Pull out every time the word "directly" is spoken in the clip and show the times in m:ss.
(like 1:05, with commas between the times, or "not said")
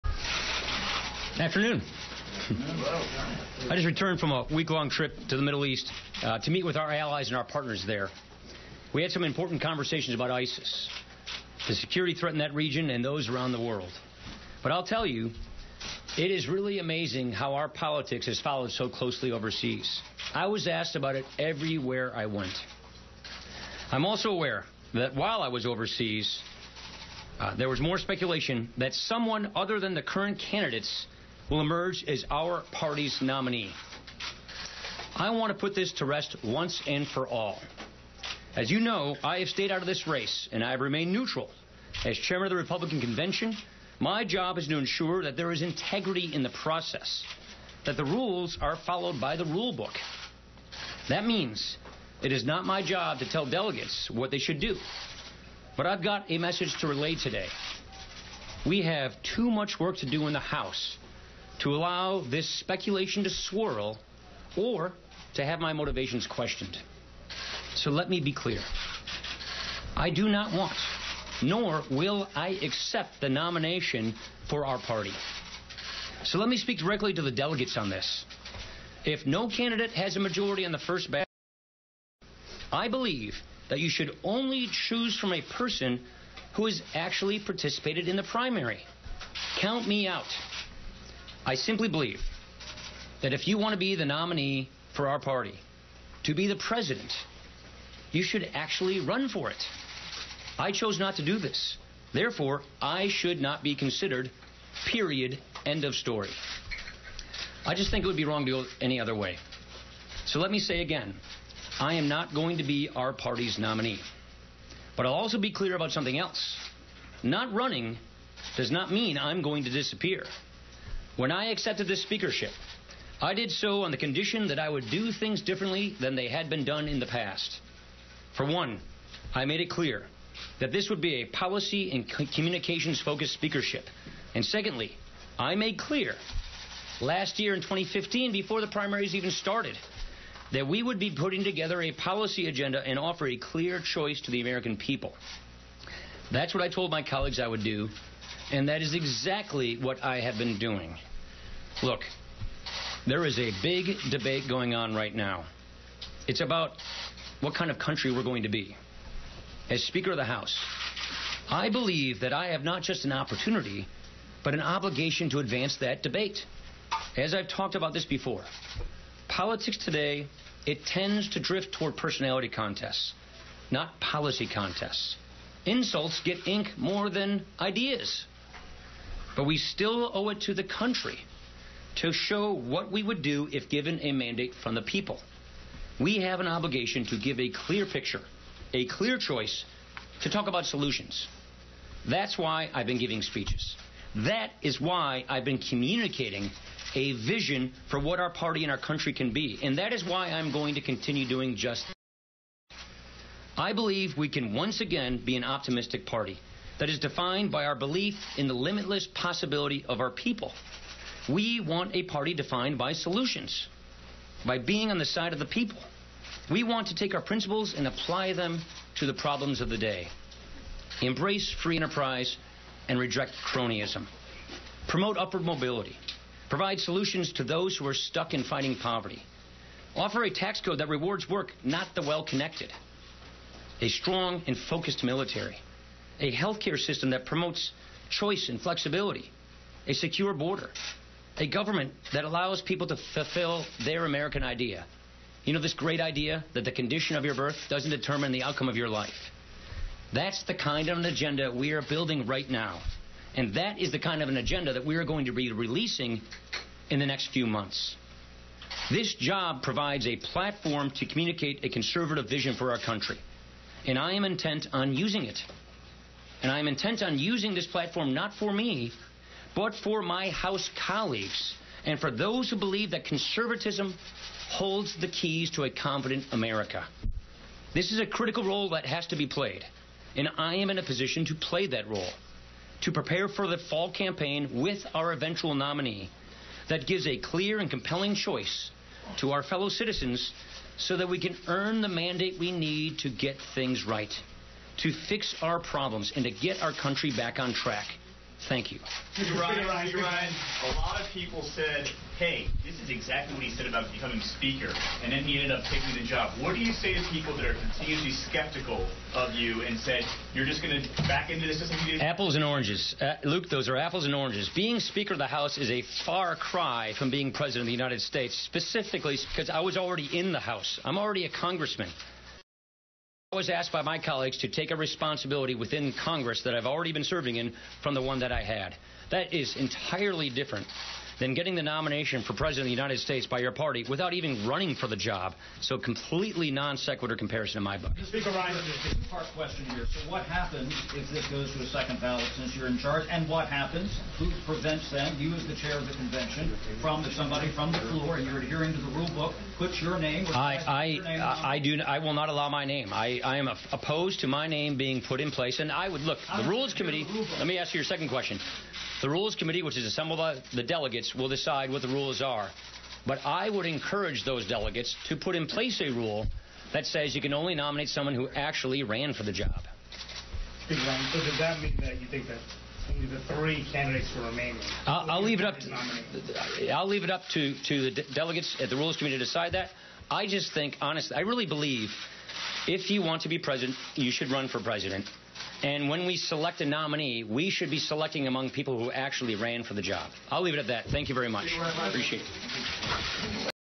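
1:16.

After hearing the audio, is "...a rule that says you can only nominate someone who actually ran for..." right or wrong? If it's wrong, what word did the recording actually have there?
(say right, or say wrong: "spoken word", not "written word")
right.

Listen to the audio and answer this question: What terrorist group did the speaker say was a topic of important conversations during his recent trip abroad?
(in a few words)
ISIS.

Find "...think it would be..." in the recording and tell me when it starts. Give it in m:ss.
1:47.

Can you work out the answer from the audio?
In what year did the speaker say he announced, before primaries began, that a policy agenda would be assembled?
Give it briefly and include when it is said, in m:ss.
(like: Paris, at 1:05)
2015, at 2:17.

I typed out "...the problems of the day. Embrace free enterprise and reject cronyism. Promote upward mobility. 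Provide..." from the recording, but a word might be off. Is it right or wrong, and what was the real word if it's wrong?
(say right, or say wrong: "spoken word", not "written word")
right.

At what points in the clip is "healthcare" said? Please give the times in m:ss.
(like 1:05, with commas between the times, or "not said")
3:56.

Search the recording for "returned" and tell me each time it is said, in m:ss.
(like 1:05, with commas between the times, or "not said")
0:03.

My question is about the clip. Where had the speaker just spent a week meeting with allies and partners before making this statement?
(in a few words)
Middle East.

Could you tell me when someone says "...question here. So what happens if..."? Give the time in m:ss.
5:39.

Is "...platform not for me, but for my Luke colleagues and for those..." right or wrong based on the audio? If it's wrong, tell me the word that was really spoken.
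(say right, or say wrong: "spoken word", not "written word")
wrong: "House", not "Luke".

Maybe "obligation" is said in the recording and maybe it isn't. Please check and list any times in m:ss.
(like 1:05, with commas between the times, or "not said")
2:44, 3:06.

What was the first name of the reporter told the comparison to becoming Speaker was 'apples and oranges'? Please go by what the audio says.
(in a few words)
Luke.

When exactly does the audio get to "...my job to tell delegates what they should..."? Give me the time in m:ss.
0:52.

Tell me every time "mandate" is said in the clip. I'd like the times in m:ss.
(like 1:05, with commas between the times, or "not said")
3:04, 4:51.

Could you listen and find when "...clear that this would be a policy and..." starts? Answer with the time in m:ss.
2:09.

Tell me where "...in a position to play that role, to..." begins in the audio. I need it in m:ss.
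4:40.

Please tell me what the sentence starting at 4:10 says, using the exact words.
That's the kind of an agenda we are building right now.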